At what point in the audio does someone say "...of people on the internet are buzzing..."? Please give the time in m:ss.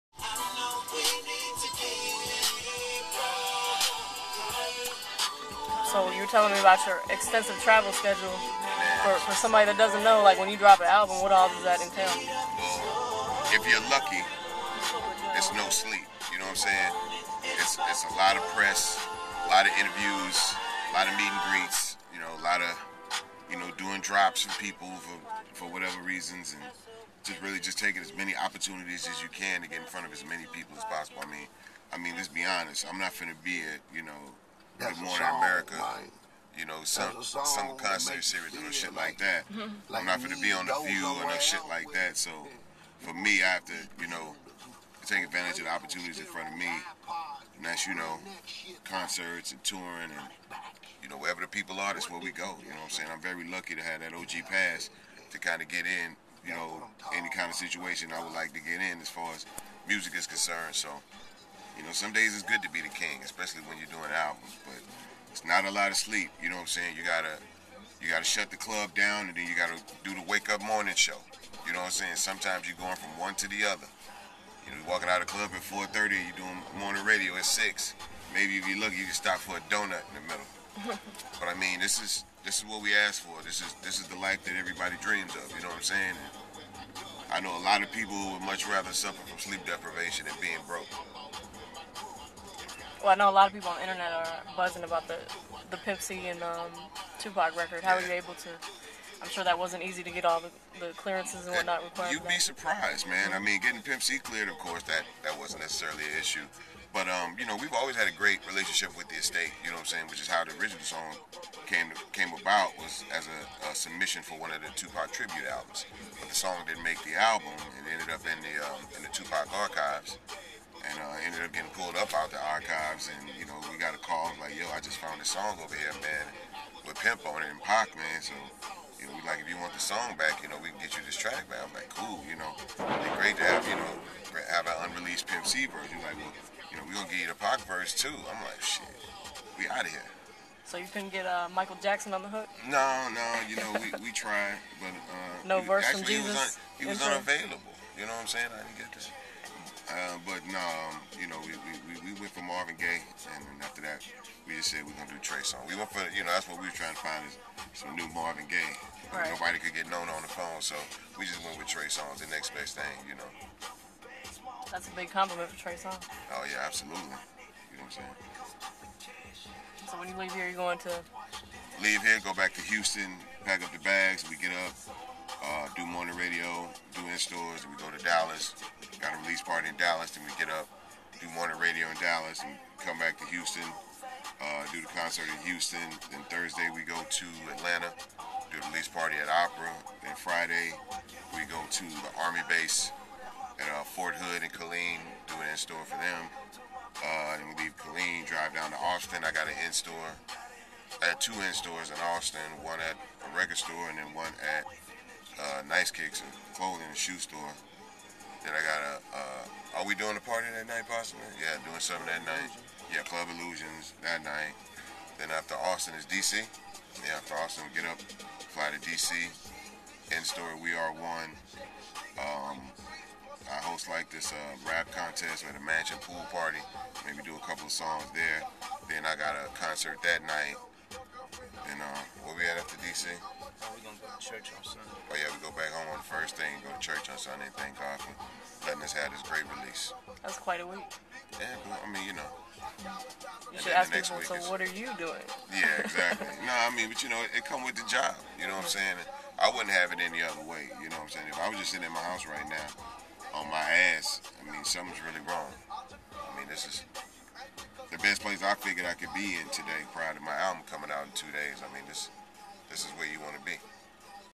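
1:33.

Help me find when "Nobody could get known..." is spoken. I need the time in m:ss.
2:39.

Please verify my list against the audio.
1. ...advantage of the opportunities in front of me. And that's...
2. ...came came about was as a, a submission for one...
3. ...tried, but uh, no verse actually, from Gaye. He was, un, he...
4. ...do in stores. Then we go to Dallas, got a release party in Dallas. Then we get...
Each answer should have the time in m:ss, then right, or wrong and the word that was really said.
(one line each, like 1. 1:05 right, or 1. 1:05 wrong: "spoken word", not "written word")
1. 0:45 right
2. 1:51 right
3. 2:24 wrong: "Jesus", not "Gaye"
4. 2:56 right.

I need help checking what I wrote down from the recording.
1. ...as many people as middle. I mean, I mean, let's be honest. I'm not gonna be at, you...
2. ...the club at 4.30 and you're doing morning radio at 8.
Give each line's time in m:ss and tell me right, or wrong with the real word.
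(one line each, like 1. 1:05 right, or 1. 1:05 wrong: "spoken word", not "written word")
1. 0:30 wrong: "possible", not "middle"
2. 1:15 wrong: "6", not "8".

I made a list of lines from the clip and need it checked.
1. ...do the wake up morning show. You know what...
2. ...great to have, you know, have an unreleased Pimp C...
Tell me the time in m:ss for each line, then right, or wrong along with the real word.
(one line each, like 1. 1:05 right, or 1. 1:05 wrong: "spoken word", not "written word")
1. 1:10 right
2. 2:13 right.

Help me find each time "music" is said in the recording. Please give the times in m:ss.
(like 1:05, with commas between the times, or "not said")
0:59.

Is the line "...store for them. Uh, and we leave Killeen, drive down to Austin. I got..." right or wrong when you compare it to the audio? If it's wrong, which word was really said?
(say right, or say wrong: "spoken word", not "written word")
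right.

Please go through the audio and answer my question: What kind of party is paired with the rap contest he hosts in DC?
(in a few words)
mansion pool party.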